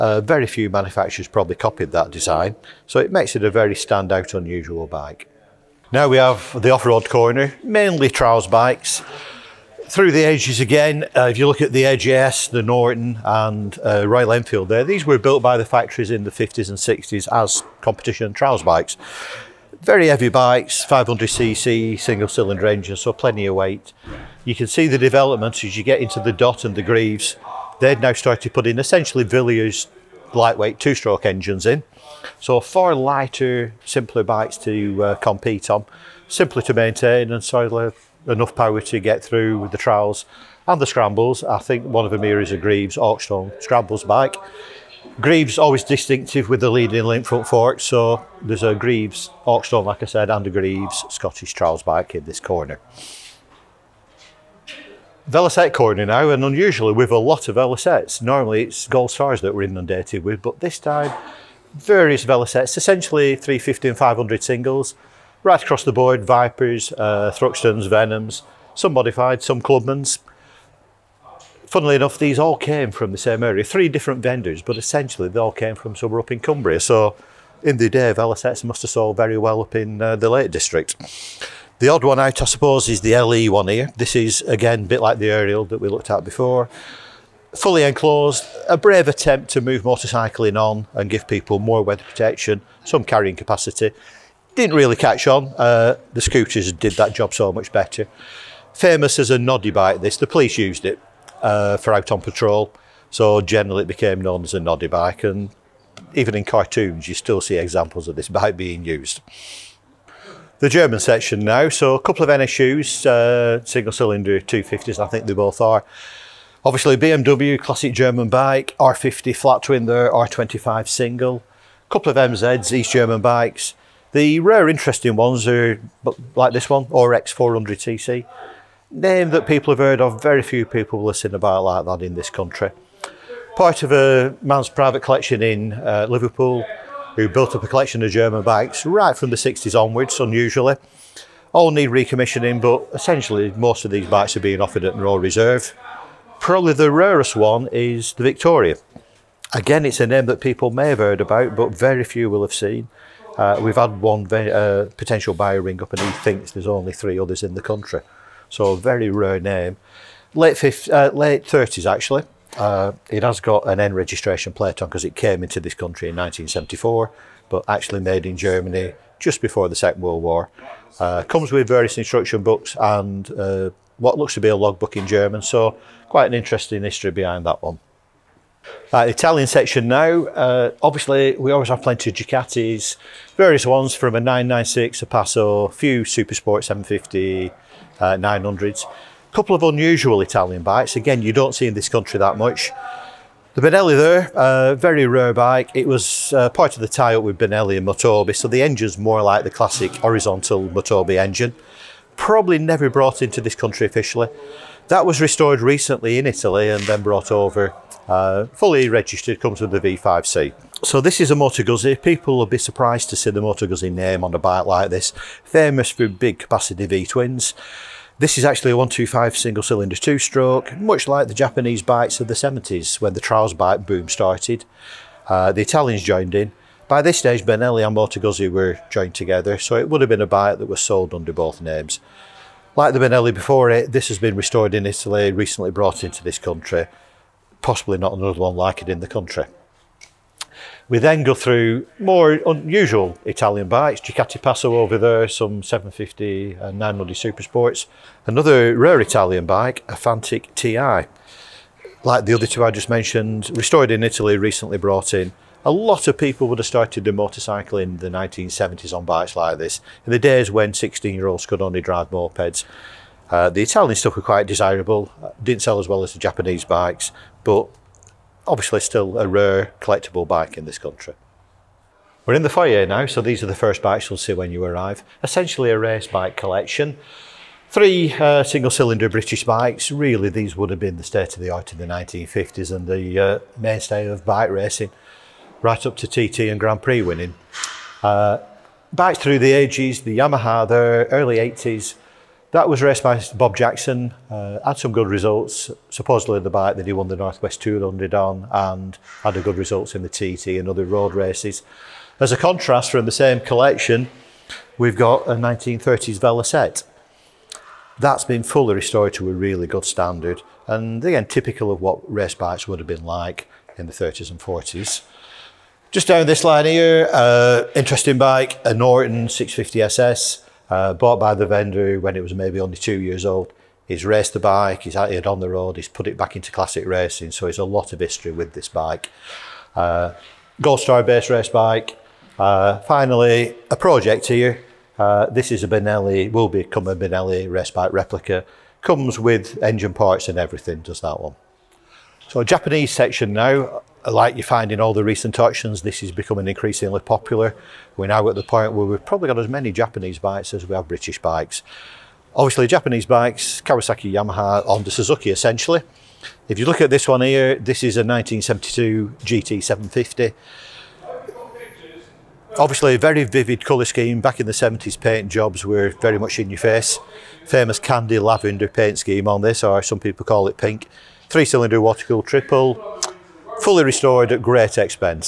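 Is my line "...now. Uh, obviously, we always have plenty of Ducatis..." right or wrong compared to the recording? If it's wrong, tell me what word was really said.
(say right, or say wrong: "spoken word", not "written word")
right.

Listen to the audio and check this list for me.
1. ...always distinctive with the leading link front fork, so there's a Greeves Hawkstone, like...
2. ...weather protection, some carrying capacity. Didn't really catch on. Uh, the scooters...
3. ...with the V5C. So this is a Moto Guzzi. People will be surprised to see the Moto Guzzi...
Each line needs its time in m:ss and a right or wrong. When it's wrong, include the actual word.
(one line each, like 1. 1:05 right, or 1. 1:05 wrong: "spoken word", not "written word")
1. 0:45 right
2. 1:31 right
3. 3:29 right.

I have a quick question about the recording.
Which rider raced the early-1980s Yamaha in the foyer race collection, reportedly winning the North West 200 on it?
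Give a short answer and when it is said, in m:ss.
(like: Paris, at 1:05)
Bob Jackson, at 4:53.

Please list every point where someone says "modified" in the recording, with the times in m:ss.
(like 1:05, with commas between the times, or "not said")
1:08.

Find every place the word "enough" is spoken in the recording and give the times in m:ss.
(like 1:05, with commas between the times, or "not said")
0:38, 1:11.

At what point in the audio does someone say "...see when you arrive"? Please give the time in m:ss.
4:34.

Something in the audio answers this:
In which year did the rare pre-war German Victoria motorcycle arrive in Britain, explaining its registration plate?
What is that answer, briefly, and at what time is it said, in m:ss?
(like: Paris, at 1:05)
1974, at 2:46.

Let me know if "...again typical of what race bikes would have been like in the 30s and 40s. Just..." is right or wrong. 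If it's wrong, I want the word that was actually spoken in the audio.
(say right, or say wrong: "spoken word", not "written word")
right.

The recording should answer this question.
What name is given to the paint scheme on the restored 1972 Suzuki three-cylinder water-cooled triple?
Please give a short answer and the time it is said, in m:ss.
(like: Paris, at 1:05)
Candy lavender, at 6:07.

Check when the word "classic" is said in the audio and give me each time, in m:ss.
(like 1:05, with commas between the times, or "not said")
1:57, 3:19, 5:26.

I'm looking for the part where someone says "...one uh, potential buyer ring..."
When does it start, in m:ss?
2:34.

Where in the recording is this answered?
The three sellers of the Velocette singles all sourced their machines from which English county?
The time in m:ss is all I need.
1:16.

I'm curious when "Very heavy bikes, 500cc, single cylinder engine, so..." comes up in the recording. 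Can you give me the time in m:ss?
0:19.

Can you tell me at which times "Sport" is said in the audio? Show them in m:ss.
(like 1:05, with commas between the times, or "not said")
3:06, 4:07.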